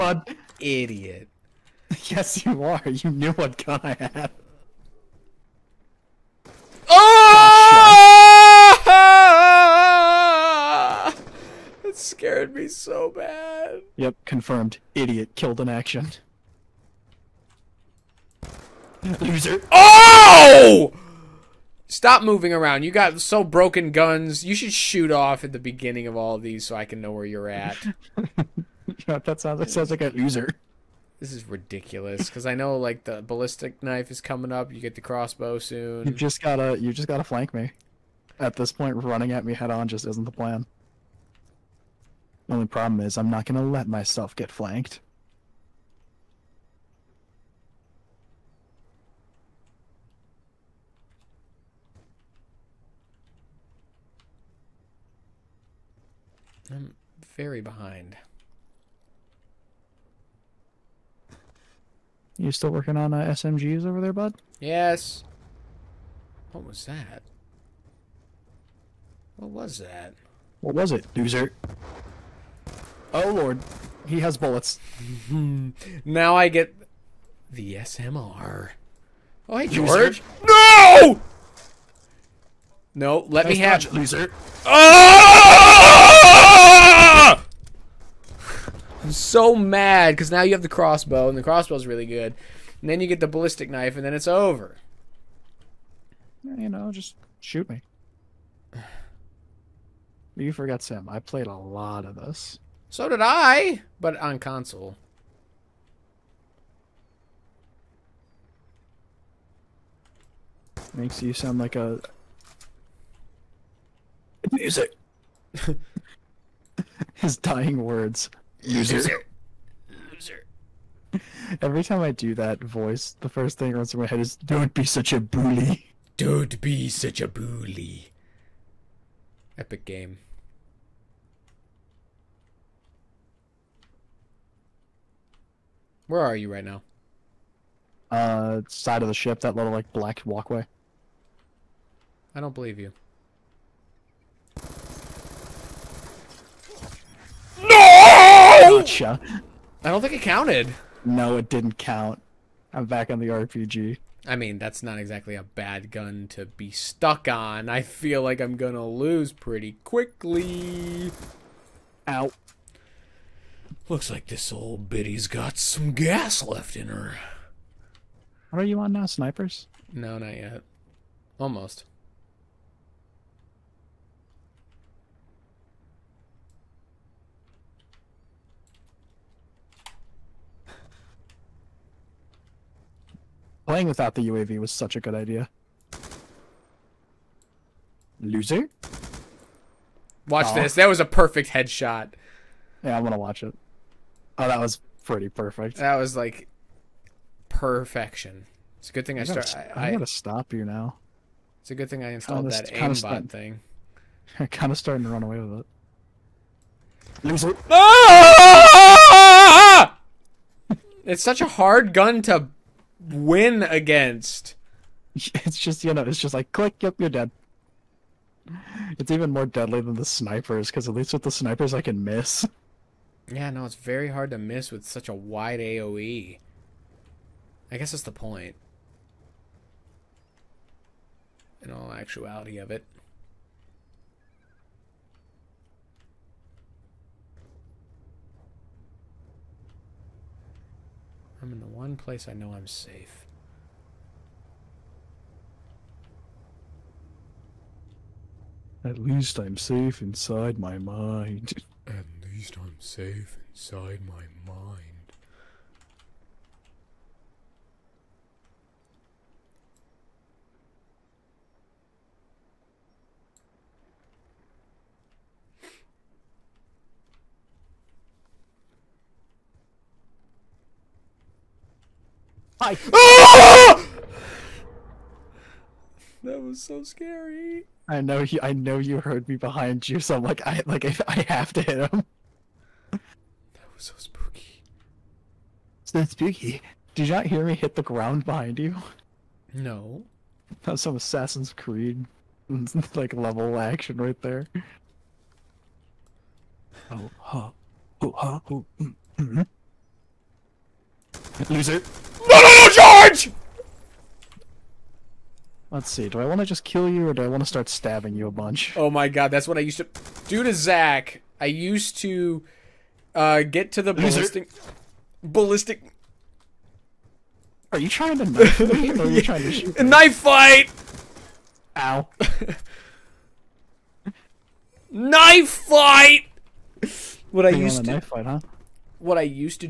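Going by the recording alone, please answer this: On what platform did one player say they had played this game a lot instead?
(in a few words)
console.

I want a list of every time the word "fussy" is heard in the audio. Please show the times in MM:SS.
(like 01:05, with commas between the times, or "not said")
not said.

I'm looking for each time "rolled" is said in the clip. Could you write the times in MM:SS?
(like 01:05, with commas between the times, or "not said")
not said.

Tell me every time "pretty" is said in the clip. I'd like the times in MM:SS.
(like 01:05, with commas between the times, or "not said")
02:39, 03:15.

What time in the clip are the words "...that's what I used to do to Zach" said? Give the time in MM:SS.
05:09.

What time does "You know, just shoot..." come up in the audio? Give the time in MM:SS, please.
01:36.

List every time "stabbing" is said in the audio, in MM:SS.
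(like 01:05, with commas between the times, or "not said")
05:07.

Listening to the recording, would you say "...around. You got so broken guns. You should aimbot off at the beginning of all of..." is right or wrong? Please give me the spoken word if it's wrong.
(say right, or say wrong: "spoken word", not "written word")
wrong: "shoot", not "aimbot".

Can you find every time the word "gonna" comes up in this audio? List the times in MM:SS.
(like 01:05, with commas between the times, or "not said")
00:43, 02:38, 03:13.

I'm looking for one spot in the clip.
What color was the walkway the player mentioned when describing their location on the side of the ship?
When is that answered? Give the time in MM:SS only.
02:19.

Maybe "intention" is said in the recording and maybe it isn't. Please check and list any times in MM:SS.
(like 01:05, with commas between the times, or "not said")
not said.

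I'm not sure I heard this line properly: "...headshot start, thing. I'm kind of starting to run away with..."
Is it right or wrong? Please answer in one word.
wrong.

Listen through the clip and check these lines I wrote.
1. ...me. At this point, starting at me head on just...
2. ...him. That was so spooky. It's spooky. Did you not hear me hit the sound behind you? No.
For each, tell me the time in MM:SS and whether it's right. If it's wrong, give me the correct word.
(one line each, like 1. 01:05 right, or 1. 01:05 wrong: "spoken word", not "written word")
1. 00:37 wrong: "running", not "starting"
2. 04:41 wrong: "ground", not "sound".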